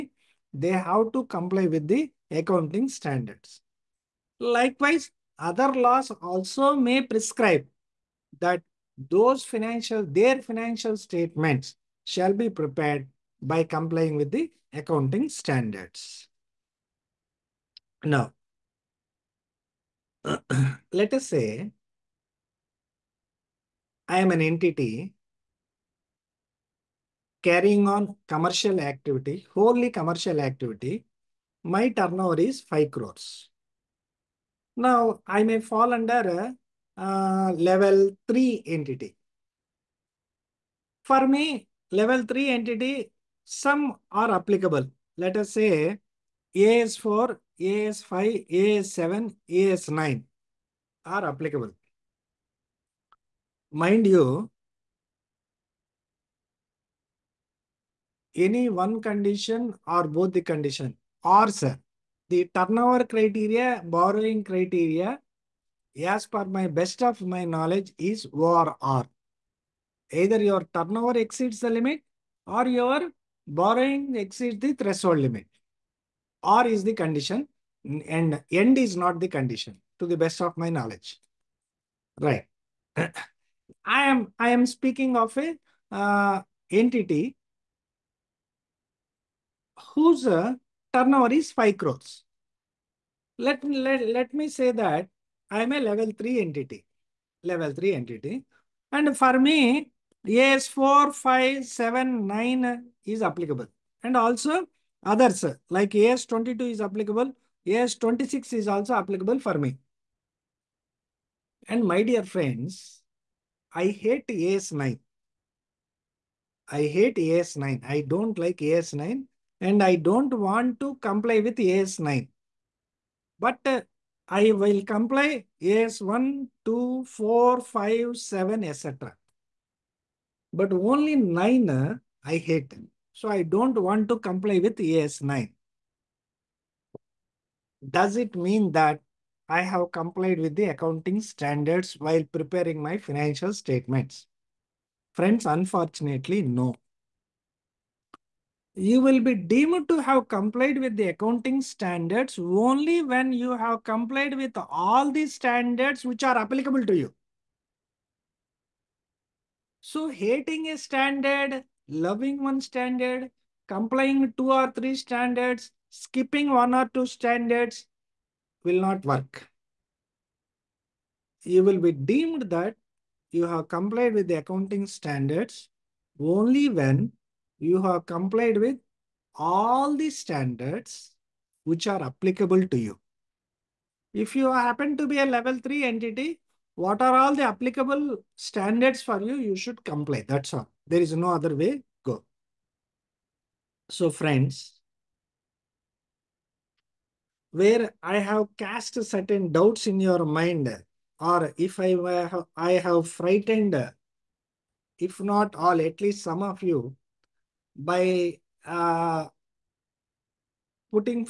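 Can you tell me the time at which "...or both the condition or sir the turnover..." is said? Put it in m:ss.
0:59.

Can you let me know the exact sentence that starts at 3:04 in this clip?
If you happen to be a level 3 entity, what are all the applicable standards for you?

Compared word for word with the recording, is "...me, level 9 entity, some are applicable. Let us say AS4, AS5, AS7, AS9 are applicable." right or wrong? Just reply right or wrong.
wrong.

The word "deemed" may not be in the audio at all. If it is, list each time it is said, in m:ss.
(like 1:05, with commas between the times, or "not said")
2:29, 2:51.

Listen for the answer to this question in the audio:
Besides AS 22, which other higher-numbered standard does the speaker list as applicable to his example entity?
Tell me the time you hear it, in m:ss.
1:47.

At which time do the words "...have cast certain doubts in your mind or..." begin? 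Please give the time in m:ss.
3:18.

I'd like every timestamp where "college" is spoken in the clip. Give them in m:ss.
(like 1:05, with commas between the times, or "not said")
not said.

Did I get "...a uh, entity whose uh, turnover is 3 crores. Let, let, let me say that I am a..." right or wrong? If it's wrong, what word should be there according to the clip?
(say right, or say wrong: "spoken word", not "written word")
wrong: "5", not "3".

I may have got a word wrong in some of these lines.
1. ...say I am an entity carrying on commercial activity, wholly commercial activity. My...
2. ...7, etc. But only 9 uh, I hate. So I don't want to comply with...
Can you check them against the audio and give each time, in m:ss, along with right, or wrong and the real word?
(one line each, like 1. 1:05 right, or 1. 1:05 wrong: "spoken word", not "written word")
1. 0:21 right
2. 2:08 right.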